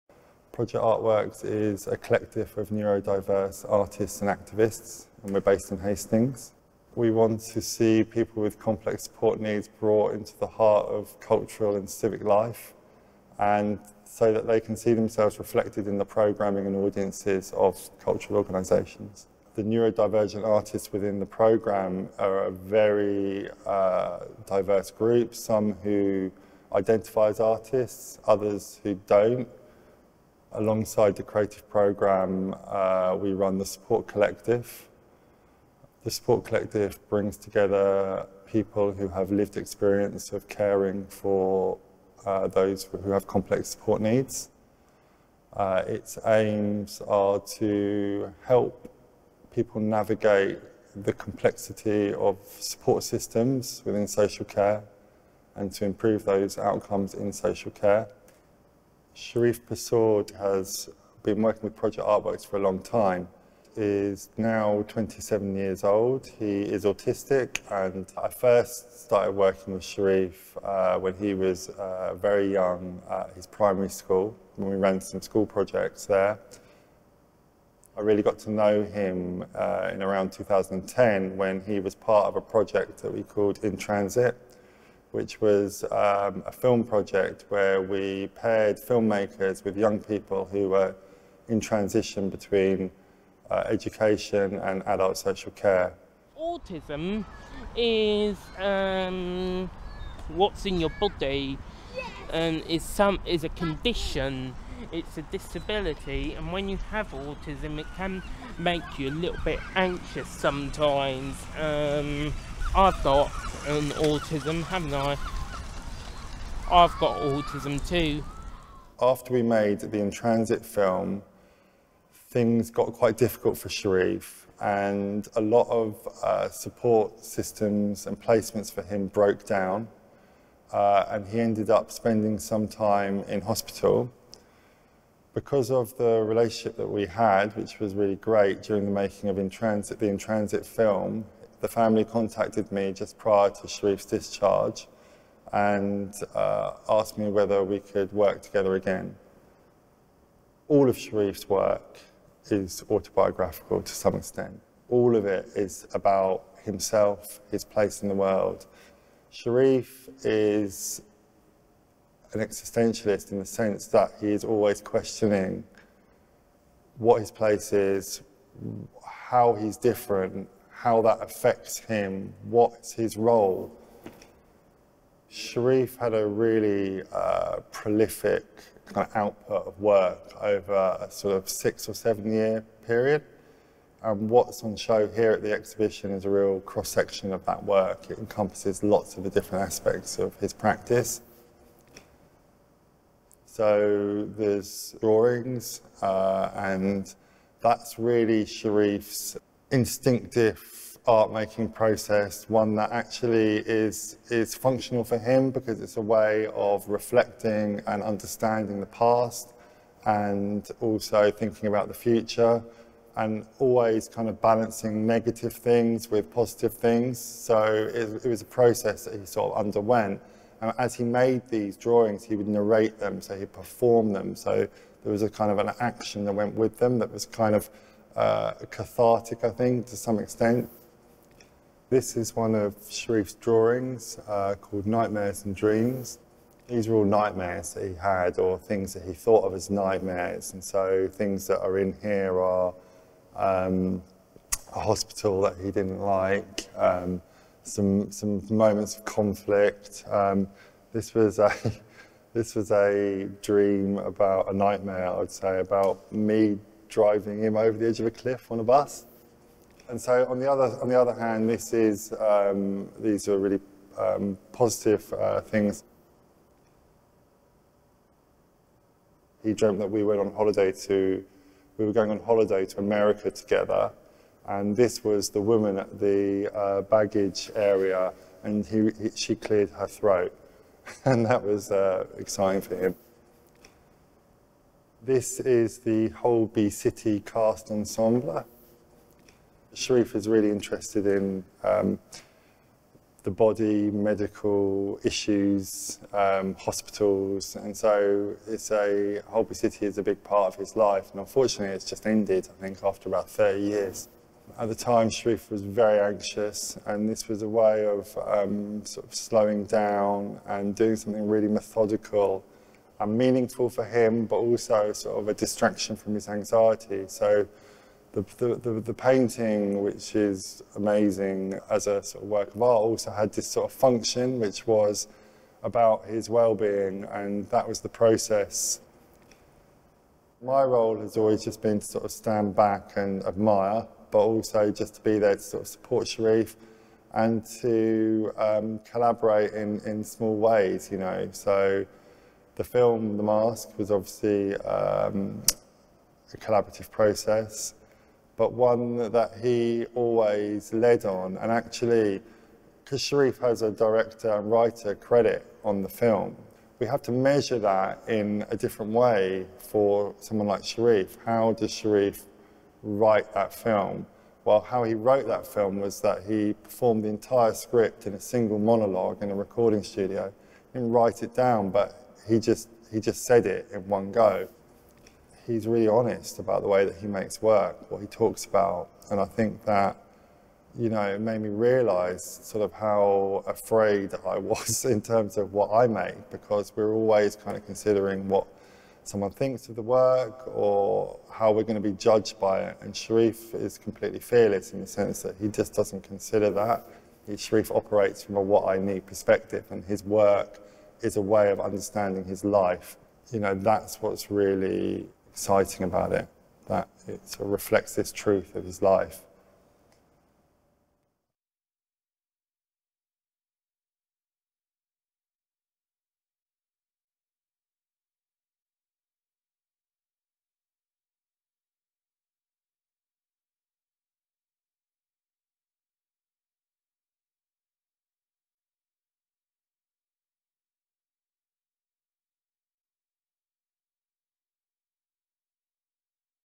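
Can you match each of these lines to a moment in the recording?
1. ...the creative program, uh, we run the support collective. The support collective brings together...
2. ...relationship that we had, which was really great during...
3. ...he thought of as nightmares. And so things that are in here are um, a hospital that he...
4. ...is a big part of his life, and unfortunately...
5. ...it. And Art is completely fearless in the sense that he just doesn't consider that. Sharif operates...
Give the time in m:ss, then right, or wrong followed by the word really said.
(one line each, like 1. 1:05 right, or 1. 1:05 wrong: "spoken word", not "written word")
1. 0:31 right
2. 2:16 right
3. 3:59 right
4. 4:59 right
5. 6:32 wrong: "Sharif", not "Art".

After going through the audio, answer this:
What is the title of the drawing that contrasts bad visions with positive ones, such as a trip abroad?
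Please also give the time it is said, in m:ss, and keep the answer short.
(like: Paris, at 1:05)
Nightmares and Dreams, at 3:54.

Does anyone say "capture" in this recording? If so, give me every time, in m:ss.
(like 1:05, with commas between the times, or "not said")
not said.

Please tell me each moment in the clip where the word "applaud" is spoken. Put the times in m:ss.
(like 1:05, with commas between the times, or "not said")
not said.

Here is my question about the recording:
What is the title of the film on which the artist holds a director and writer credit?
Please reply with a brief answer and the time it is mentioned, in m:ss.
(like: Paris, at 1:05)
The Mask, at 5:43.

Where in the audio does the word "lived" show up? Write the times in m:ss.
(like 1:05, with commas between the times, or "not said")
0:39.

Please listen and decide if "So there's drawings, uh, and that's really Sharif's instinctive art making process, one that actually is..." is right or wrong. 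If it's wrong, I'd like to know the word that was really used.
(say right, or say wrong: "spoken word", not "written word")
right.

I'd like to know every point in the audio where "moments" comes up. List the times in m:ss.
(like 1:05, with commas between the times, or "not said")
4:08.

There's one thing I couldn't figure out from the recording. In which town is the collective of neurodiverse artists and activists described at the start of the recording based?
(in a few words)
Hastings.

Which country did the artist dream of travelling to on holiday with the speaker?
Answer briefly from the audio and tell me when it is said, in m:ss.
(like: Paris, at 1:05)
America, at 4:32.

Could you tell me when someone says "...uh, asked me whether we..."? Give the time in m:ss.
2:26.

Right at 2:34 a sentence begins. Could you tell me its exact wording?
All of it is about himself, his place in the world.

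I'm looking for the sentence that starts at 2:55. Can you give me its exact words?
Sharif had a really uh, prolific kind of output of work over a sort of six or seven year period.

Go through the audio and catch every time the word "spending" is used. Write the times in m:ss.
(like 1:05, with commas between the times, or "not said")
2:11.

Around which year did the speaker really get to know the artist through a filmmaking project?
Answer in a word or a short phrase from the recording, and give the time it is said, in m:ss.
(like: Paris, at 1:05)
2010, at 1:20.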